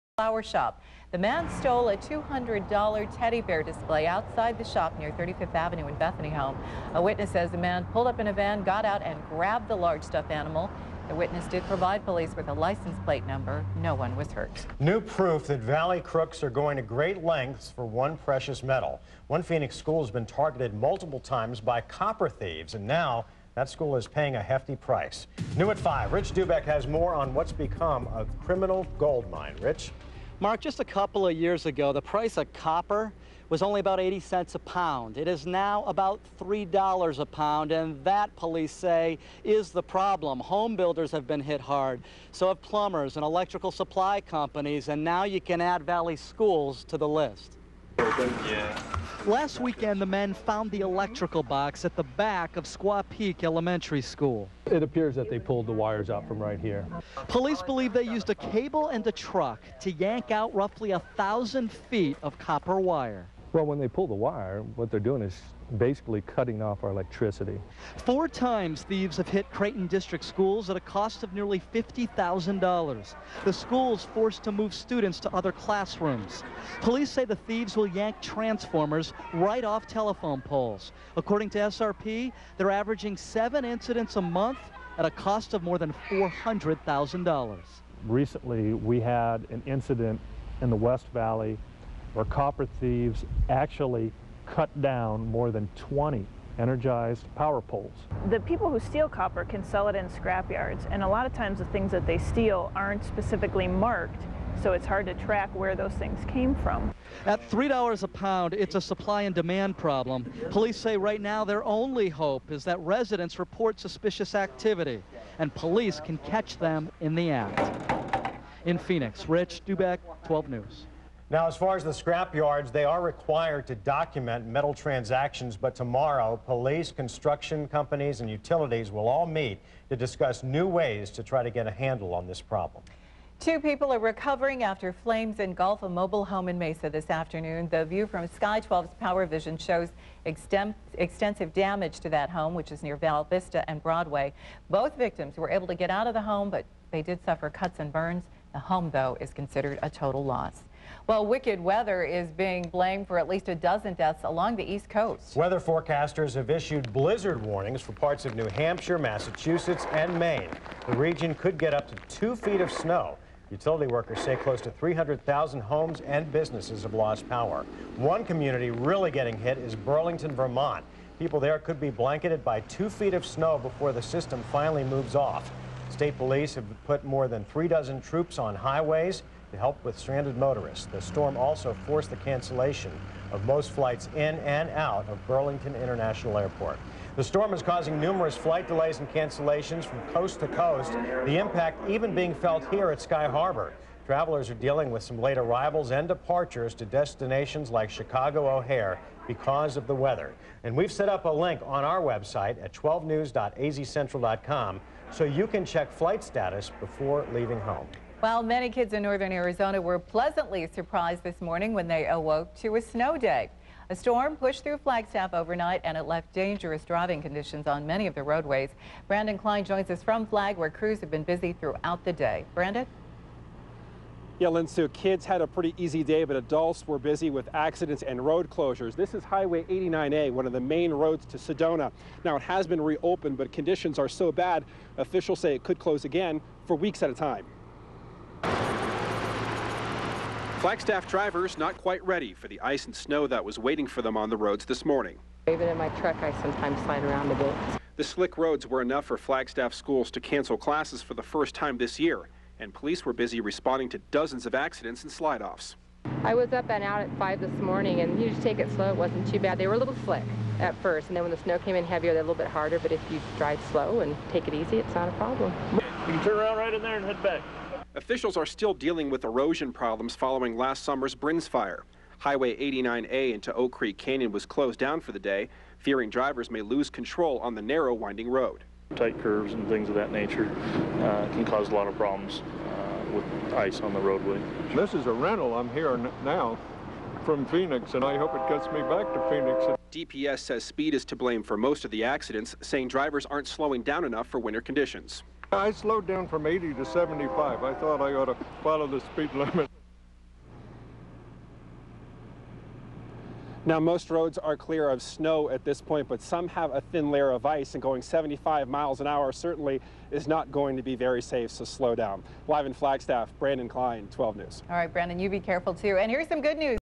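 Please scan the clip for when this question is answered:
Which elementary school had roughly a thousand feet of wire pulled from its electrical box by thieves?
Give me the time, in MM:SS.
00:52.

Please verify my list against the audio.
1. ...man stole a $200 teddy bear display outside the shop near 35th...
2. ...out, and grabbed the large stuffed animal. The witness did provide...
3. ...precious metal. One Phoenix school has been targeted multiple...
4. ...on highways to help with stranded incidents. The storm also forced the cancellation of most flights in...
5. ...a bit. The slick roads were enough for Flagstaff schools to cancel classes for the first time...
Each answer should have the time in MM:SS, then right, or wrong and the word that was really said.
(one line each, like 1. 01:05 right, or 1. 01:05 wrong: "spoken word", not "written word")
1. 00:01 right
2. 00:08 right
3. 00:18 right
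4. 02:58 wrong: "motorists", not "incidents"
5. 04:07 right.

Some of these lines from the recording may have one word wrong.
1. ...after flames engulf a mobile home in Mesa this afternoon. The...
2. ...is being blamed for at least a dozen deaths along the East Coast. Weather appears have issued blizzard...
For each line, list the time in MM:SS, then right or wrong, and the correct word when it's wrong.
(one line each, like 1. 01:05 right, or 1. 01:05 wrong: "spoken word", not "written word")
1. 02:14 right
2. 02:32 wrong: "forecasters", not "appears".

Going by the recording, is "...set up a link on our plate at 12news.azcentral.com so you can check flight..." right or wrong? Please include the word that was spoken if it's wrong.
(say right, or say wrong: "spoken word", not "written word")
wrong: "website", not "plate".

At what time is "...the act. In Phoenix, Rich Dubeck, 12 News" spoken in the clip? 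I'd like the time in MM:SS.
01:57.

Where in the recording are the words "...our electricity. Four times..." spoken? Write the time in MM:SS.
01:06.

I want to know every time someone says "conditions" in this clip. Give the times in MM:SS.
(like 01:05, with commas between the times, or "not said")
03:37, 03:53, 04:54.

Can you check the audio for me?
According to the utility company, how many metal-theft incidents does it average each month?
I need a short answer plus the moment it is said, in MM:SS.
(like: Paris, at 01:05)
7, at 01:23.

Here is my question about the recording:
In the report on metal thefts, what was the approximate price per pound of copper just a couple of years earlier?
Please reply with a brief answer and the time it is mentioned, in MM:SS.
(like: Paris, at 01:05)
80 cents, at 00:33.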